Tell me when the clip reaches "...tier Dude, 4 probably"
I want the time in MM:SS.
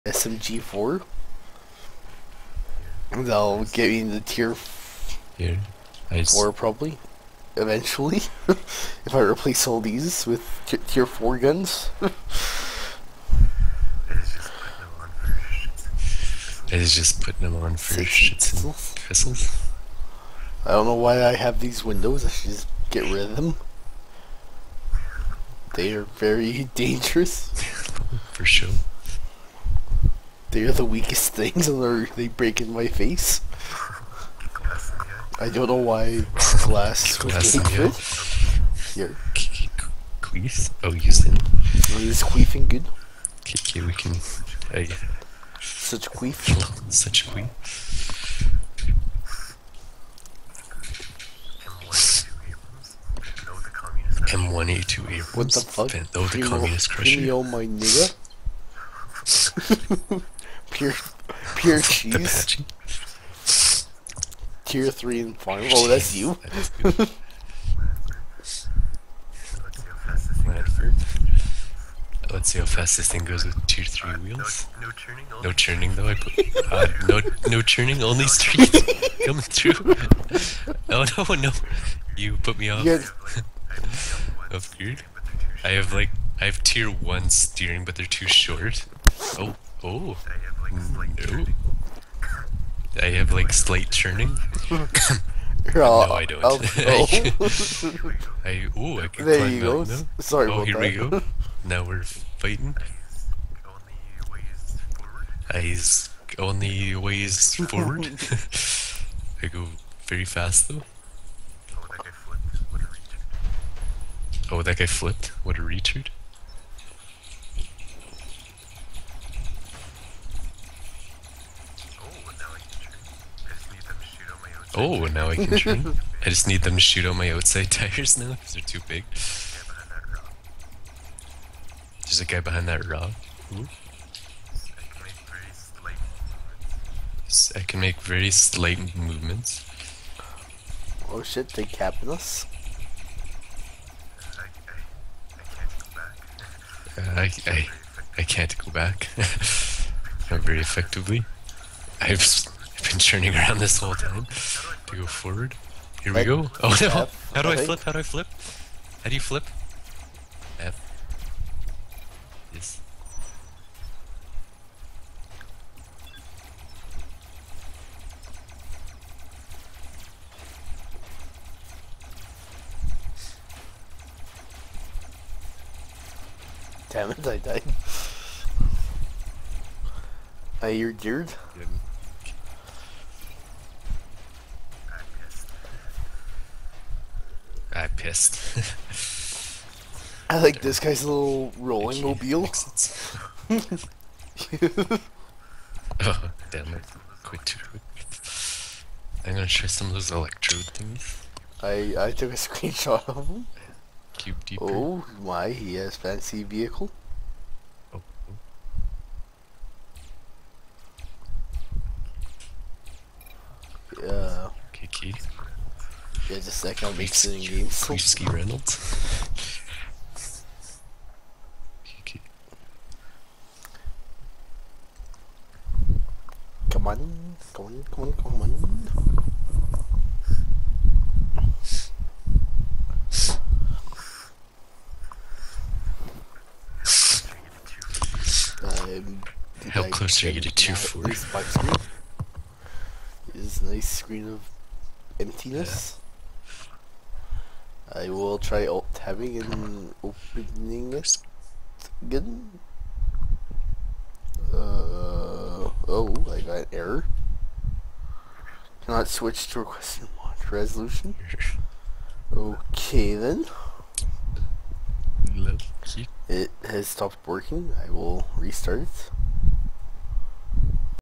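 00:04.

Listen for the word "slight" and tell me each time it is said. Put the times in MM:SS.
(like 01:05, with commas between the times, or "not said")
01:33, 02:18.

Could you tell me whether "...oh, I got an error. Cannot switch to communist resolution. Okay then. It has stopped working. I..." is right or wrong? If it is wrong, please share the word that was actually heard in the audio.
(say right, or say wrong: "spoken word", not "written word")
wrong: "request", not "communist".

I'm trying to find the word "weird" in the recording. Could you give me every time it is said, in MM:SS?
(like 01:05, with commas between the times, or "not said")
01:24.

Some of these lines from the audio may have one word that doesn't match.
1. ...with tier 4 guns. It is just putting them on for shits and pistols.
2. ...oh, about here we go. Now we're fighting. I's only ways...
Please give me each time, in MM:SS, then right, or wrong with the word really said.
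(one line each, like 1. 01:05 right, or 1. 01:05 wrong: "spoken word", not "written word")
1. 00:10 right
2. 01:40 right.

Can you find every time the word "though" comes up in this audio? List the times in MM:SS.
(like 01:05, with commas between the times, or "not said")
00:56, 01:15, 01:50.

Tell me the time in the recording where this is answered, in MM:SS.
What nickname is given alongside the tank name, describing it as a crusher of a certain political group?
00:56.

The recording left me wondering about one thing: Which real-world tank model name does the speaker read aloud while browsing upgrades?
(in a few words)
M1A2 Abrams.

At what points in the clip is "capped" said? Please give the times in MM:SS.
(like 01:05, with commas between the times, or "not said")
02:21.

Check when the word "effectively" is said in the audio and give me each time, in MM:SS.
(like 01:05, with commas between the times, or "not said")
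02:30.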